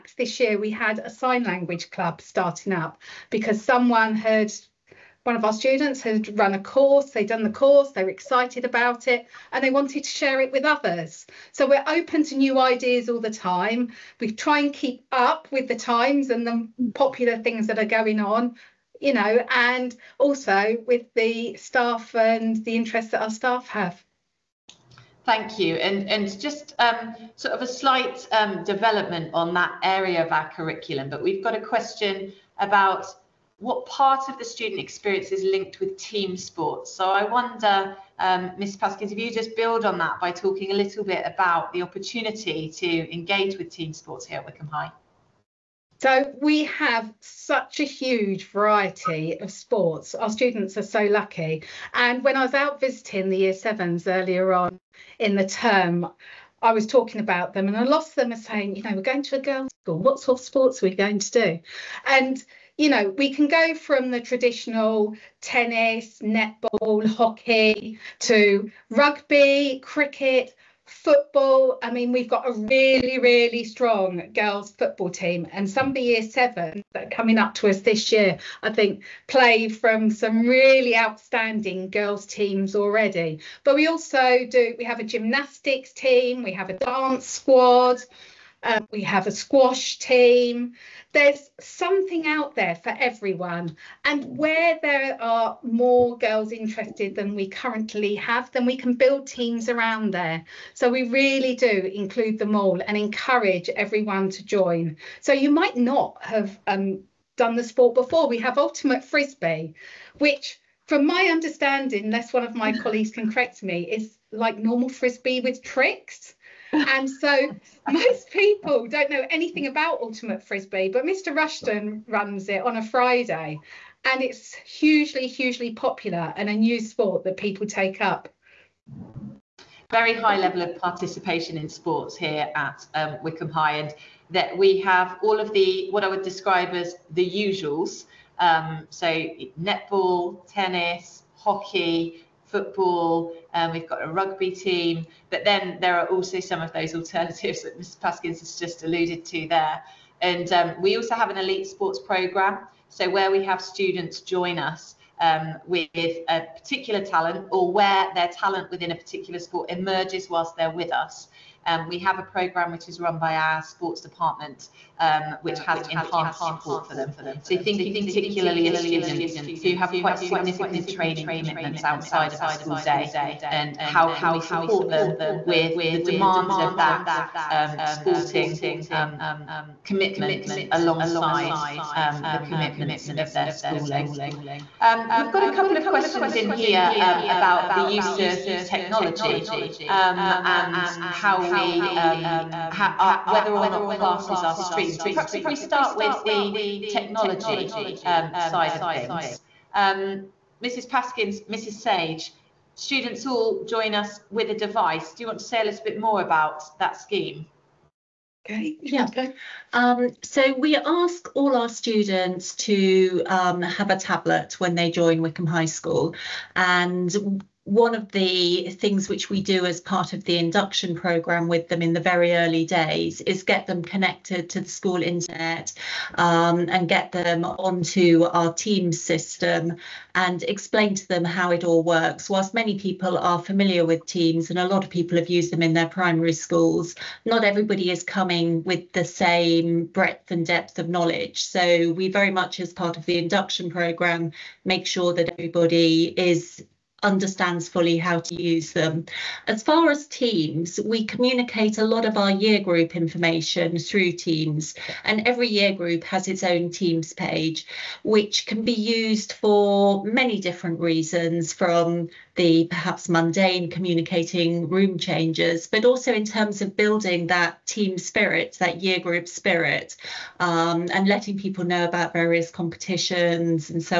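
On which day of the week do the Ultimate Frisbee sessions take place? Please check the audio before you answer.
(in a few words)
Friday.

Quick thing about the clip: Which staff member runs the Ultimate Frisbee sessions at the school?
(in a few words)
Mr Rushton.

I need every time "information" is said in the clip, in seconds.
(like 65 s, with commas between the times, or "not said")
252 s.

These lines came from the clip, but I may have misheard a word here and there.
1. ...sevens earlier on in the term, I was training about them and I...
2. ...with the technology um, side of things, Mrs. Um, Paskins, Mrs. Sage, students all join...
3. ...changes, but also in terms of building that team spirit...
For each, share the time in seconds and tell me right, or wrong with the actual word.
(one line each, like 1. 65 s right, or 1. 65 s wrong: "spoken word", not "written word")
1. 53 s wrong: "talking", not "training"
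2. 195 s right
3. 264 s right.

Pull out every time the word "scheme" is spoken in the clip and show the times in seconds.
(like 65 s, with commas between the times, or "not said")
206 s.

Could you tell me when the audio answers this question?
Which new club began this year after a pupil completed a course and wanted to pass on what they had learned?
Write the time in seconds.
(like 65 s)
1 s.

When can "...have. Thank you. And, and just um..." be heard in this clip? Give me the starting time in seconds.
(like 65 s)
23 s.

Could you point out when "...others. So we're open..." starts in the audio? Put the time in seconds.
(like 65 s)
10 s.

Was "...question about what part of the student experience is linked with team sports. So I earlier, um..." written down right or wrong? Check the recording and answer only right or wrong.
wrong.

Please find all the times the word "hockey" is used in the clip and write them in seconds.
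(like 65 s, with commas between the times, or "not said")
67 s, 141 s.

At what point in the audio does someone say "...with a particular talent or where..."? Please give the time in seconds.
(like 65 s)
155 s.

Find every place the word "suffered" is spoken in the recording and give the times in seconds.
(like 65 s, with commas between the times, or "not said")
not said.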